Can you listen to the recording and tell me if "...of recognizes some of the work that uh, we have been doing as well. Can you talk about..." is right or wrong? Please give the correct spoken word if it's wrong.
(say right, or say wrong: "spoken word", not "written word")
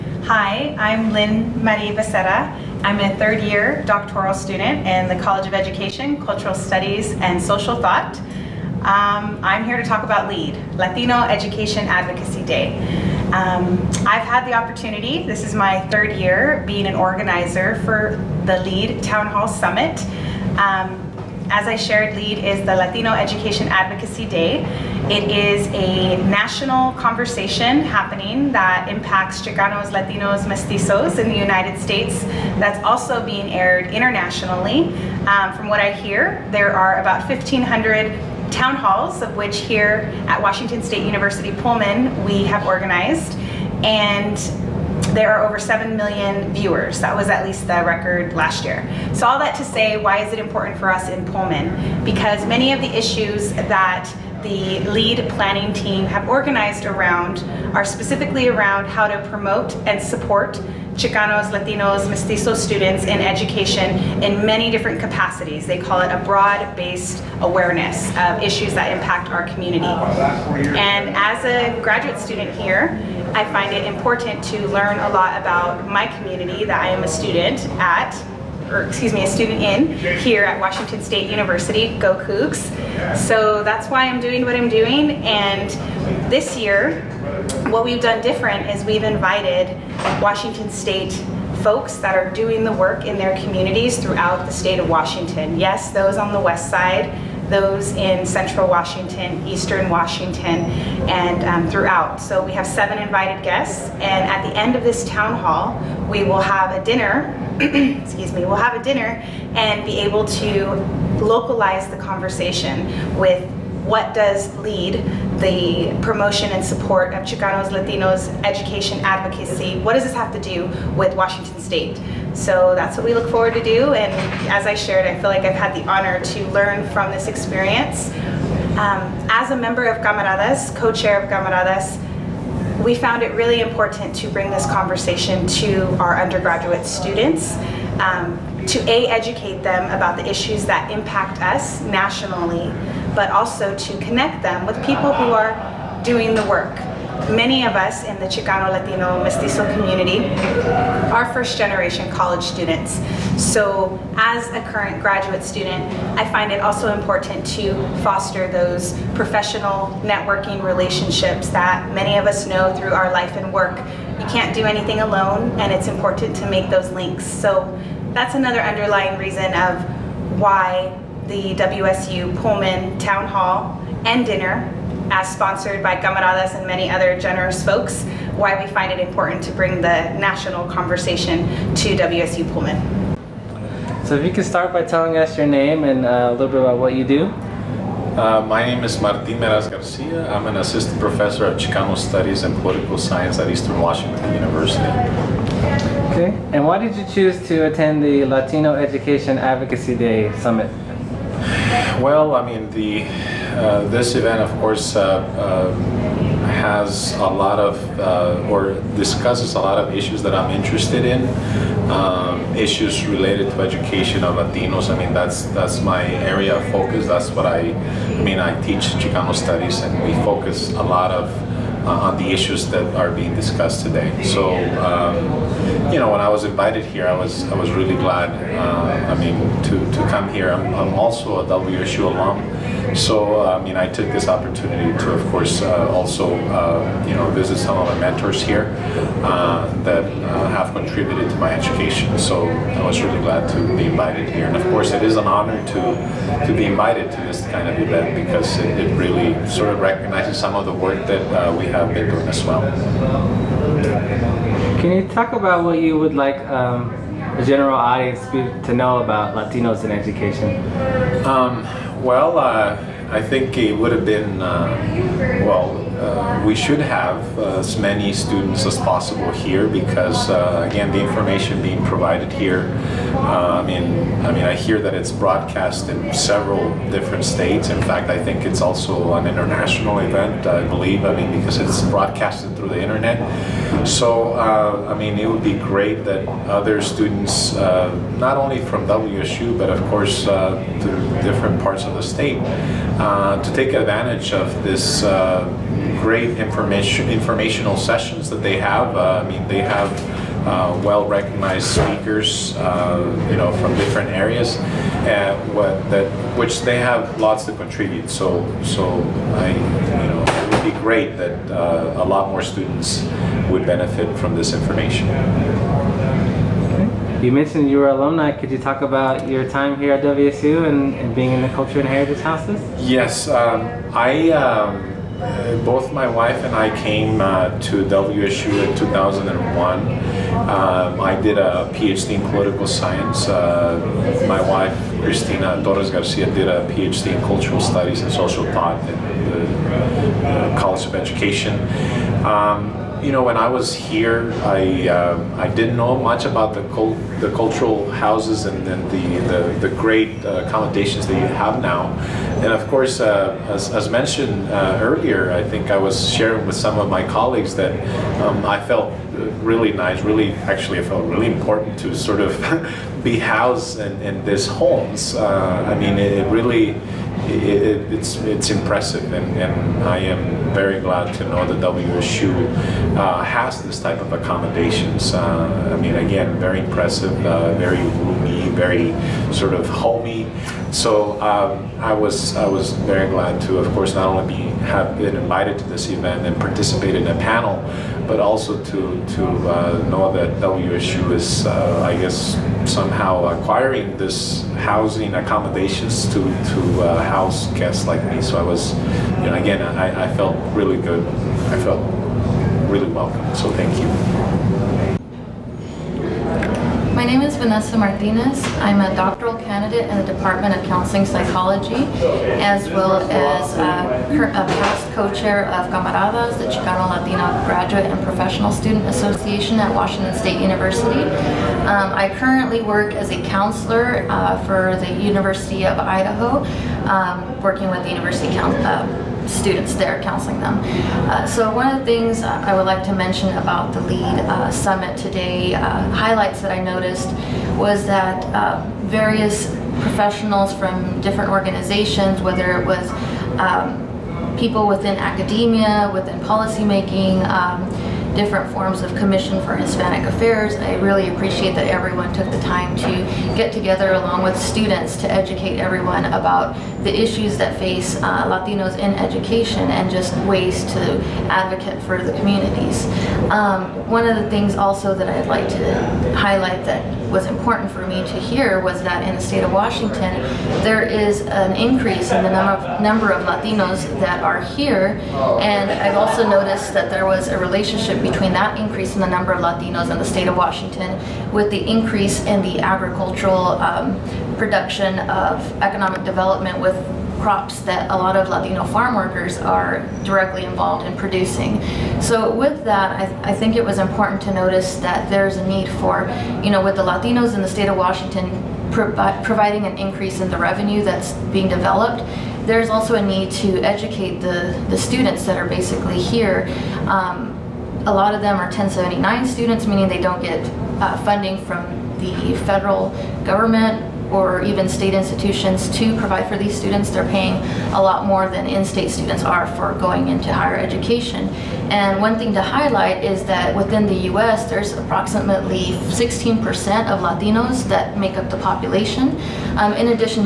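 right.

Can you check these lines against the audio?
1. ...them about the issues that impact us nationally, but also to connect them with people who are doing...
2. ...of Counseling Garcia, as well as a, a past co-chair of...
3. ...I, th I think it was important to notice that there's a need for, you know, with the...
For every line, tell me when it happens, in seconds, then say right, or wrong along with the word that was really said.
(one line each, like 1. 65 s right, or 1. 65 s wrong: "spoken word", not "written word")
1. 139 s right
2. 410 s wrong: "Psychology", not "Garcia"
3. 493 s right.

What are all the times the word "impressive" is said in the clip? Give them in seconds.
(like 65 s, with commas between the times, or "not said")
368 s, 376 s.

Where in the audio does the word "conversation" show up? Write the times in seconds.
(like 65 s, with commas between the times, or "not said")
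26 s, 111 s, 134 s, 180 s.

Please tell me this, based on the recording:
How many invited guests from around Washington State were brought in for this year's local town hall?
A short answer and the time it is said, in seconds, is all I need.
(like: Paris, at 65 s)
7, at 102 s.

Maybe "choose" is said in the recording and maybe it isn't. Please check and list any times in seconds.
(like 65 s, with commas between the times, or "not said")
197 s.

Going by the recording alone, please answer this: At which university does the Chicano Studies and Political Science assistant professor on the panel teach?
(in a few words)
Eastern Washington University.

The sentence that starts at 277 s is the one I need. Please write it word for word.
In fact, I think it's also an international event, I believe, I mean, because it's broadcasted through the internet.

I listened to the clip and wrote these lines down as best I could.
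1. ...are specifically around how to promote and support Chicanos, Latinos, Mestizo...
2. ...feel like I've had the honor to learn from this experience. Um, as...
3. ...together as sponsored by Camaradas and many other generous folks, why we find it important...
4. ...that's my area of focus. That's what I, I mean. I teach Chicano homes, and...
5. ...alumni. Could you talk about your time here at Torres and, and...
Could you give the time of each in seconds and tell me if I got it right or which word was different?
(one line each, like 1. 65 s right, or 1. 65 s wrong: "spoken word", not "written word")
1. 57 s right
2. 125 s right
3. 174 s wrong: "dinner", not "together"
4. 215 s wrong: "studies", not "homes"
5. 317 s wrong: "WSU", not "Torres".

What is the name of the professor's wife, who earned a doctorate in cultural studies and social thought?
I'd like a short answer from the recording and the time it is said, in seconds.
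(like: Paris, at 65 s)
Cristina Torres Garcia, at 335 s.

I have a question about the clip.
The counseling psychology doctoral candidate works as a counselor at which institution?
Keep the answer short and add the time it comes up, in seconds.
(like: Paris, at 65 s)
University of Idaho, at 425 s.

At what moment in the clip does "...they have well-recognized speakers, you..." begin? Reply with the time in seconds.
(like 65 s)
299 s.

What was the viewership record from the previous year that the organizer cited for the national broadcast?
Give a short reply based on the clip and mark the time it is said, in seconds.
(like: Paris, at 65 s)
over 7 million, at 45 s.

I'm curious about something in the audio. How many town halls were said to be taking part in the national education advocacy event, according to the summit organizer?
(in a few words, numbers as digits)
1,500.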